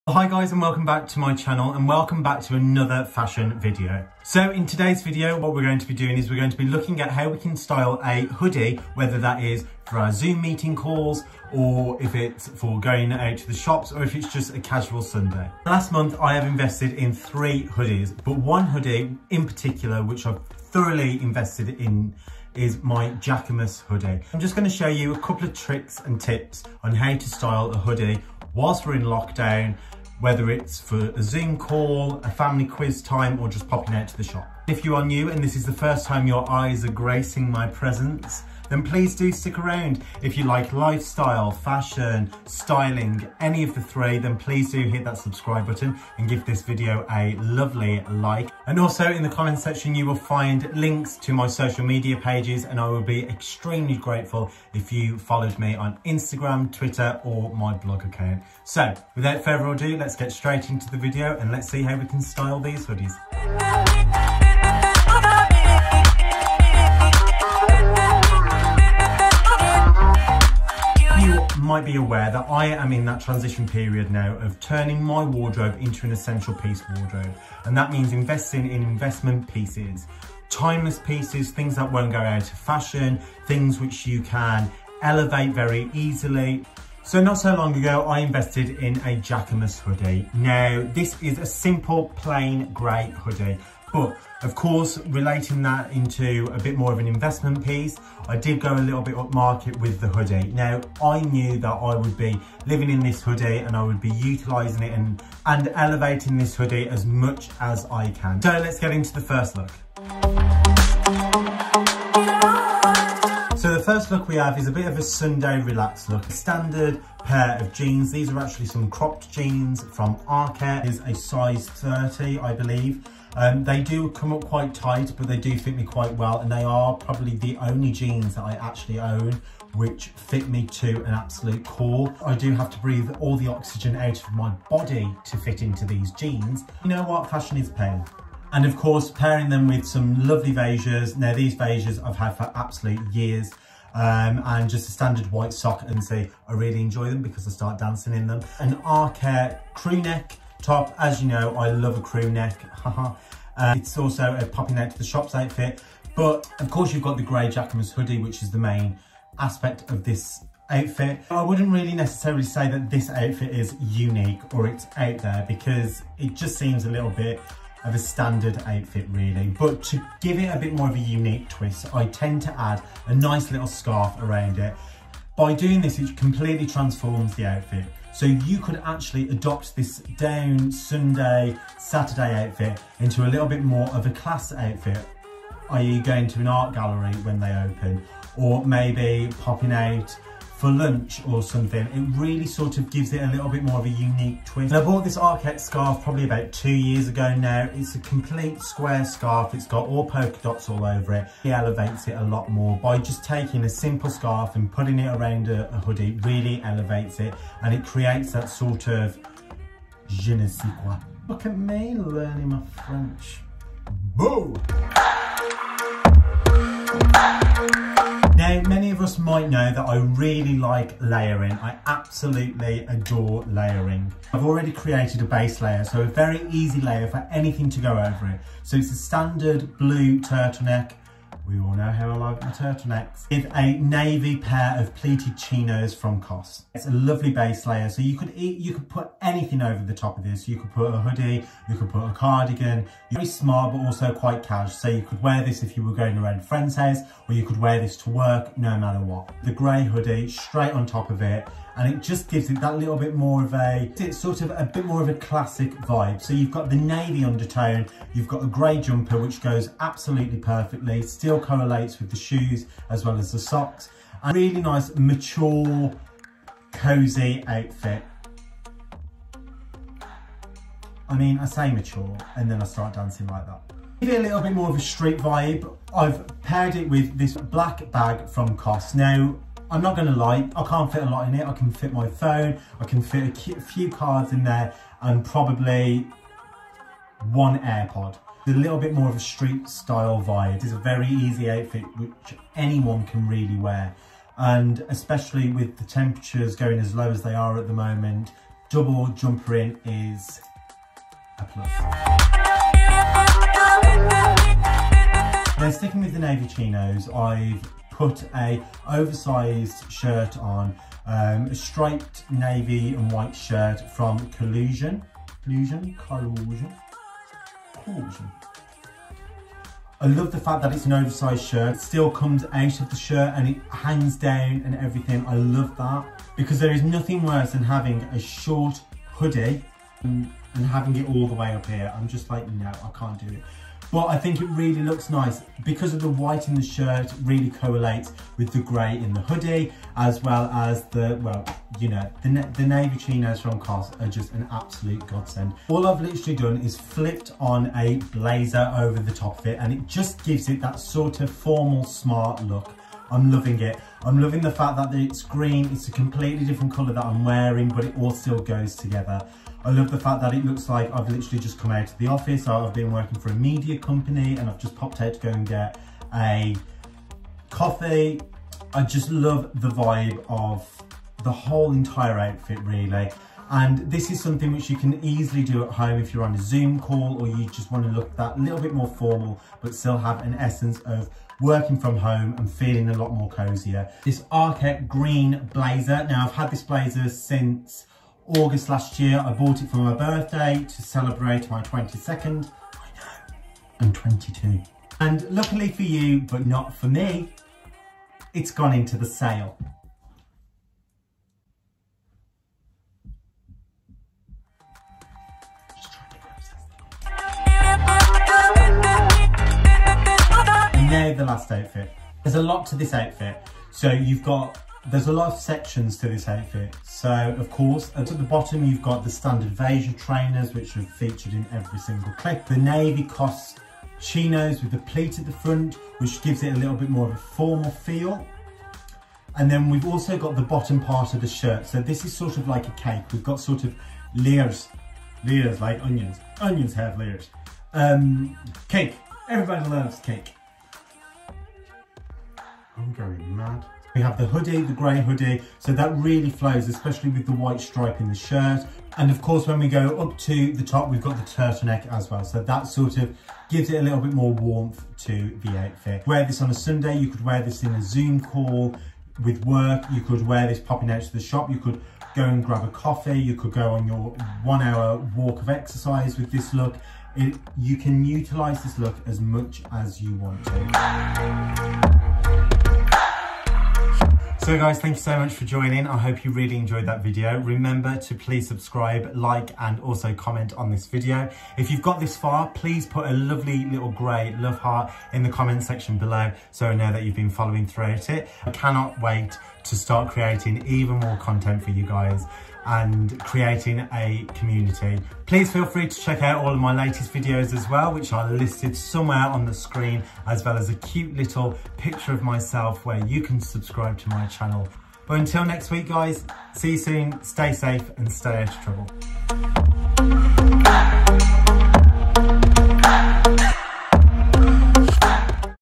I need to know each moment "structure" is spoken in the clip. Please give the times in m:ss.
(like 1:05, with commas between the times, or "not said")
not said.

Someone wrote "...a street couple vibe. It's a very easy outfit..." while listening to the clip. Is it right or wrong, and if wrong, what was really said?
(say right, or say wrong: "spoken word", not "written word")
wrong: "style", not "couple".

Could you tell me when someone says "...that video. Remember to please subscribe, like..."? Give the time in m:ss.
7:56.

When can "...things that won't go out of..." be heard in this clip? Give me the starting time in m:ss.
1:21.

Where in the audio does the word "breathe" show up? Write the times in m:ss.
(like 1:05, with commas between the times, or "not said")
2:12.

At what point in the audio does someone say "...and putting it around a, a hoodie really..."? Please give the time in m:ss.
3:24.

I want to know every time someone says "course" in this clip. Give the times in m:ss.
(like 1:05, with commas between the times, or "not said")
1:34, 2:18, 2:36, 6:57, 7:29.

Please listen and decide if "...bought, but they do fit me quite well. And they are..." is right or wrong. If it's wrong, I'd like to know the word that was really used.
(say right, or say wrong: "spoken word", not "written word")
wrong: "tight", not "bought".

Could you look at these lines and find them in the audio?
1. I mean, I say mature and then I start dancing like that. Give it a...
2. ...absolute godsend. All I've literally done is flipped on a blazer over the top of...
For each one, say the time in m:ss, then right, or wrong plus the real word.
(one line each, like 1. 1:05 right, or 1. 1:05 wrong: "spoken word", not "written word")
1. 4:31 right
2. 5:44 right.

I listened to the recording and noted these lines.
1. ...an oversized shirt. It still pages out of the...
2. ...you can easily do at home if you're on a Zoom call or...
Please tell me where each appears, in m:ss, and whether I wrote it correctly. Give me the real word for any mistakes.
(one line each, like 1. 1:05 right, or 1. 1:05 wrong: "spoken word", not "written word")
1. 5:20 wrong: "comes", not "pages"
2. 6:14 right.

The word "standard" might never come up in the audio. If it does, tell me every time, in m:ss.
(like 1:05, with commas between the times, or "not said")
1:56, 2:24, 2:47, 3:48, 6:59.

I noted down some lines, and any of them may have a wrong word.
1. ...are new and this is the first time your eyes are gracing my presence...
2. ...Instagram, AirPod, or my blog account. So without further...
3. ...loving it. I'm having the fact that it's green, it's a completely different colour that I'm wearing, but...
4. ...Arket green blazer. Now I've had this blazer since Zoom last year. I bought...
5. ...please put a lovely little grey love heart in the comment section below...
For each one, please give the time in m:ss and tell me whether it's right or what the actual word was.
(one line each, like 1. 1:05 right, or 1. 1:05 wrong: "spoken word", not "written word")
1. 0:34 right
2. 0:56 wrong: "Twitter", not "AirPod"
3. 5:53 wrong: "loving", not "having"
4. 6:24 wrong: "August", not "Zoom"
5. 8:02 right.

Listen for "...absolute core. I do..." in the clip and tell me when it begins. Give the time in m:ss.
2:11.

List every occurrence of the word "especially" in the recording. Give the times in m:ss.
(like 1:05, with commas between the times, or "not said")
4:54, 7:26.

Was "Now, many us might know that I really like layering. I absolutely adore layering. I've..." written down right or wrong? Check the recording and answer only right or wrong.
right.